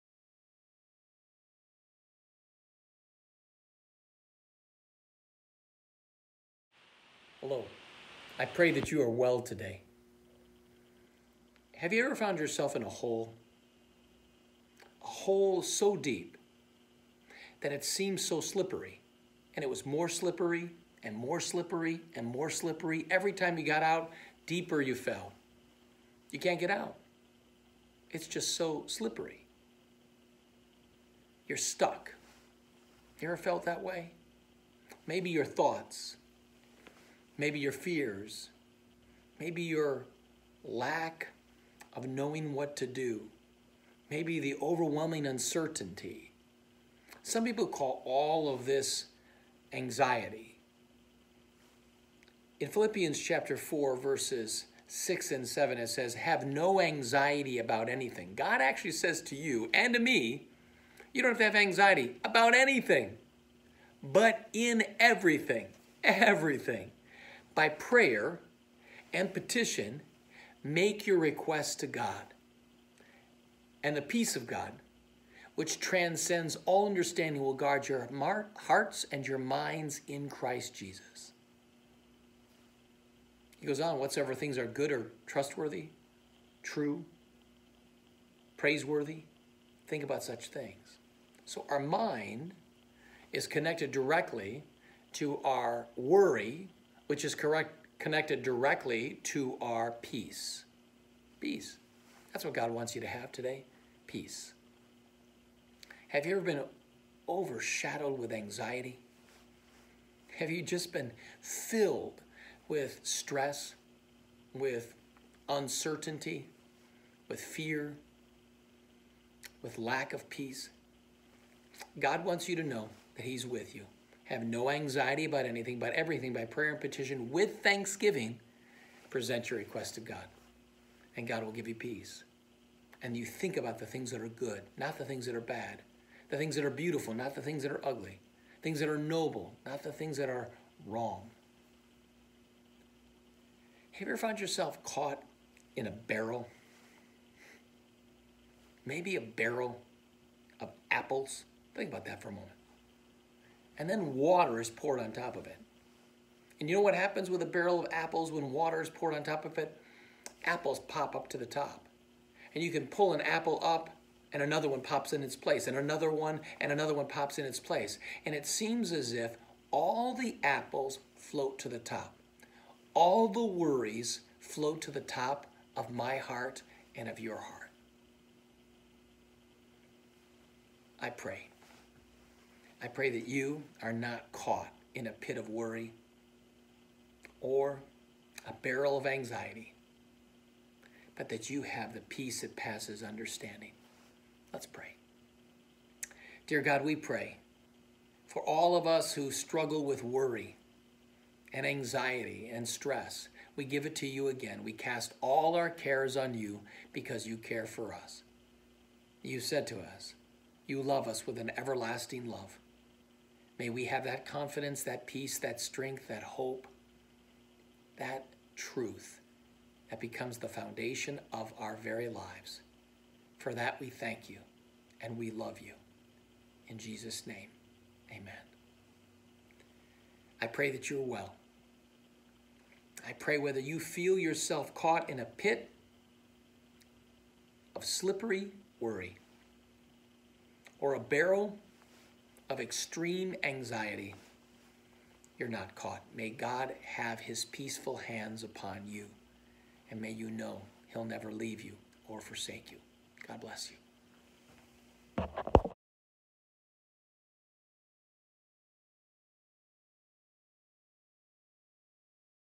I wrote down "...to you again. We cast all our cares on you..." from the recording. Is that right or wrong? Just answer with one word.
right.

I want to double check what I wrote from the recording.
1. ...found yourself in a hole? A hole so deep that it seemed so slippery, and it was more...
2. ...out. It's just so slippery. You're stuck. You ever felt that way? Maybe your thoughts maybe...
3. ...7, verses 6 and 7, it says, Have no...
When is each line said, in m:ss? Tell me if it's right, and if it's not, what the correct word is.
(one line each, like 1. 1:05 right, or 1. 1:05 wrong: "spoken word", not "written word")
1. 0:12 right
2. 0:26 right
3. 0:53 wrong: "4", not "7".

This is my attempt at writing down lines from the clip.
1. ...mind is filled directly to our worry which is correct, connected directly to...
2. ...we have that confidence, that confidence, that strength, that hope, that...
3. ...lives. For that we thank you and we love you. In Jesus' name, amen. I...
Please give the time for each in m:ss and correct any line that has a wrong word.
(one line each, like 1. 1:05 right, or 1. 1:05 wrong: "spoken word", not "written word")
1. 1:31 wrong: "connected", not "filled"
2. 3:33 wrong: "peace", not "confidence"
3. 3:42 right.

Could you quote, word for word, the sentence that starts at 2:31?
Think about that for a moment and then water is poured on top of it.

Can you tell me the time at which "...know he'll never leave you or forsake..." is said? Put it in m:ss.
4:10.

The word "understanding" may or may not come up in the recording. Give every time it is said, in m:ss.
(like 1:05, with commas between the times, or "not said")
1:16, 3:13.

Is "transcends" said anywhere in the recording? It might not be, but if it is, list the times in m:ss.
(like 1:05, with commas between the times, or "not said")
1:15.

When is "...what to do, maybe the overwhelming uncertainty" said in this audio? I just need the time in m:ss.
0:42.